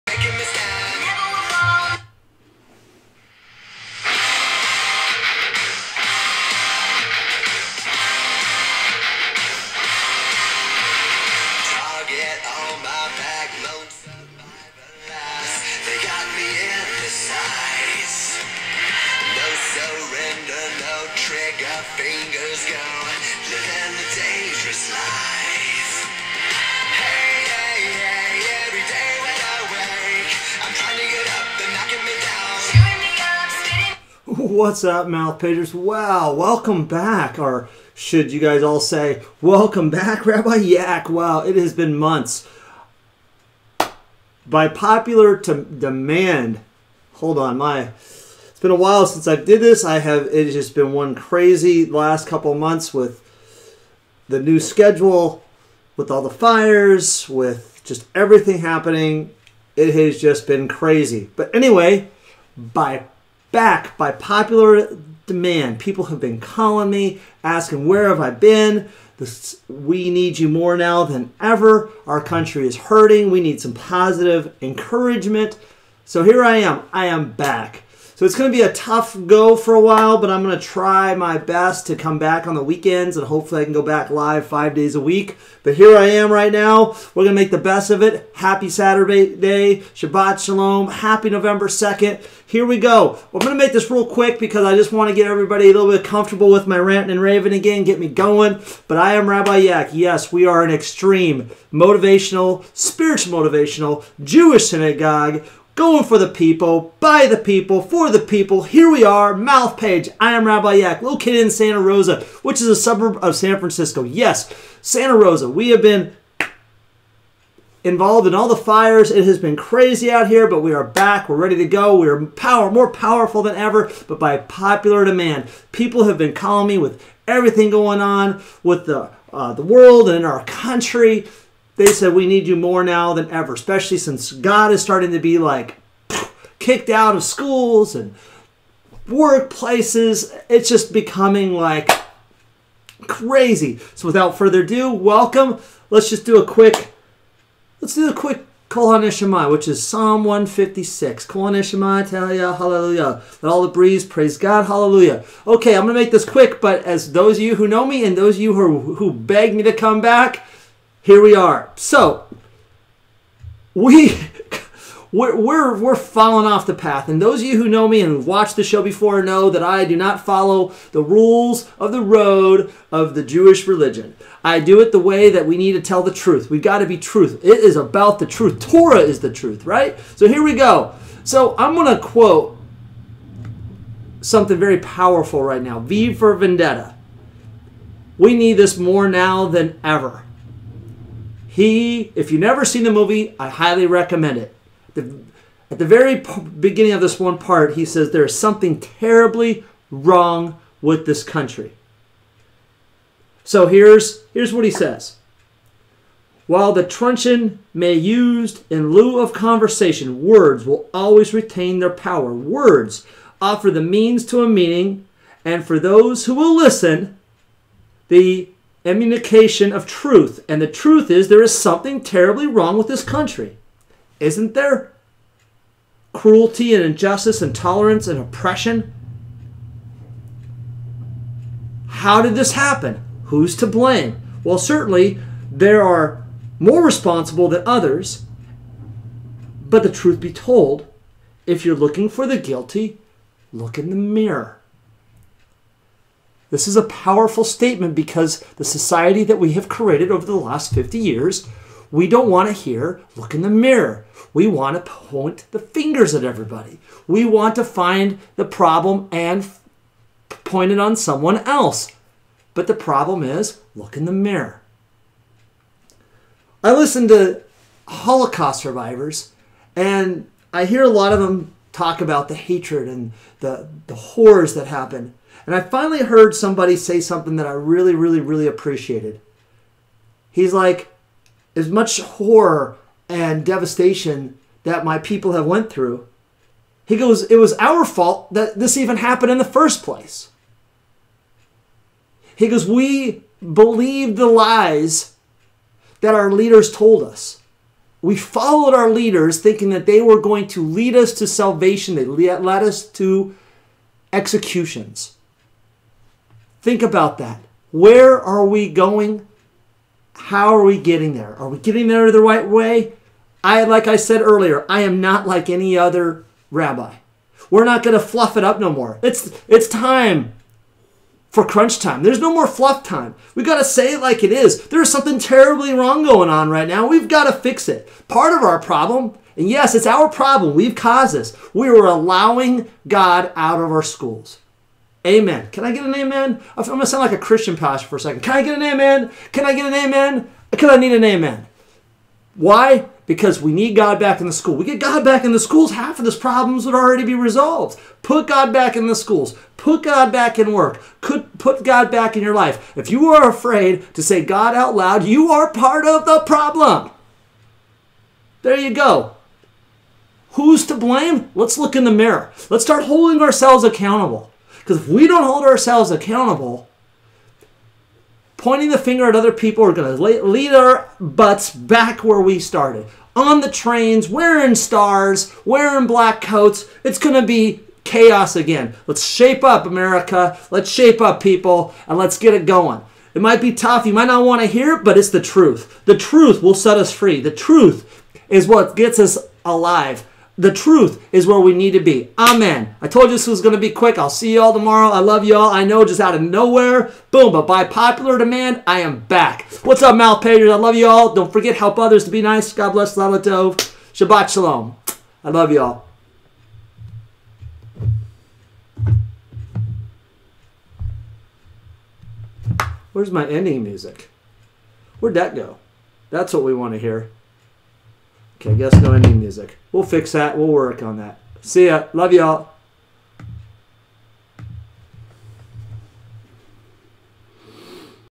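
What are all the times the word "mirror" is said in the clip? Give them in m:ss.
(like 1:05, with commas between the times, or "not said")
4:03, 4:13, 4:24, 6:01.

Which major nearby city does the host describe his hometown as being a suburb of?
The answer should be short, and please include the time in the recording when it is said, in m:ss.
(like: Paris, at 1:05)
San Francisco, at 1:53.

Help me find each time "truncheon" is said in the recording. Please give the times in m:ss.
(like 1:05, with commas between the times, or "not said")
3:26.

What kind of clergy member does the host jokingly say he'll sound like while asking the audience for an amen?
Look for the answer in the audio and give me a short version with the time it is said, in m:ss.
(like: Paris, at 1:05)
Christian pastor, at 5:37.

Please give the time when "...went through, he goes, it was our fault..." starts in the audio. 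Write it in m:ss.
4:45.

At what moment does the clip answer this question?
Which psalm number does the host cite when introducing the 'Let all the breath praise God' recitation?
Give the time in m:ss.
2:29.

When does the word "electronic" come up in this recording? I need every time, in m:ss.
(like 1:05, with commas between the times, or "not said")
not said.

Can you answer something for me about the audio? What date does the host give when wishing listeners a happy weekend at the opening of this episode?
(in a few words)
November 2nd.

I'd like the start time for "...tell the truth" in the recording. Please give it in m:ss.
2:55.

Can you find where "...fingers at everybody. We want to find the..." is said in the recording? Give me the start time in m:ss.
4:15.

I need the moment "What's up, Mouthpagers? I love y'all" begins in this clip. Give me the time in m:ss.
6:39.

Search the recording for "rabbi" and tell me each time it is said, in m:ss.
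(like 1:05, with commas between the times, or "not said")
0:40, 1:39, 1:50, 5:16.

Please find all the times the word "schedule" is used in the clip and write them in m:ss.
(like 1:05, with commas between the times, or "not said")
0:54.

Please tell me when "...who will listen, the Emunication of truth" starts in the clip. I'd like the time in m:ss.
3:36.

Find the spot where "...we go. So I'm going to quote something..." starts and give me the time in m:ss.
3:00.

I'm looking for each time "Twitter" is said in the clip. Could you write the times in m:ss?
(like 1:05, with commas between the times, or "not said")
not said.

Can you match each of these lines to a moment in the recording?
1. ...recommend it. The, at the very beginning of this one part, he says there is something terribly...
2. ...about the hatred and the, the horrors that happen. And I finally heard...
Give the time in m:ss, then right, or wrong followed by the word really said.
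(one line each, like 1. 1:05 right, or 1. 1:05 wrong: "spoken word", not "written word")
1. 3:13 right
2. 4:32 right.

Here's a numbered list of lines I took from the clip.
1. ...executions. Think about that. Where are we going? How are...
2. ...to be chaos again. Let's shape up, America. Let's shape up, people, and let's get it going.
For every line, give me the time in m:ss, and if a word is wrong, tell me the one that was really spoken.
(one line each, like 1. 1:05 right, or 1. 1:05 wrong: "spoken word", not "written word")
1. 5:04 right
2. 6:17 right.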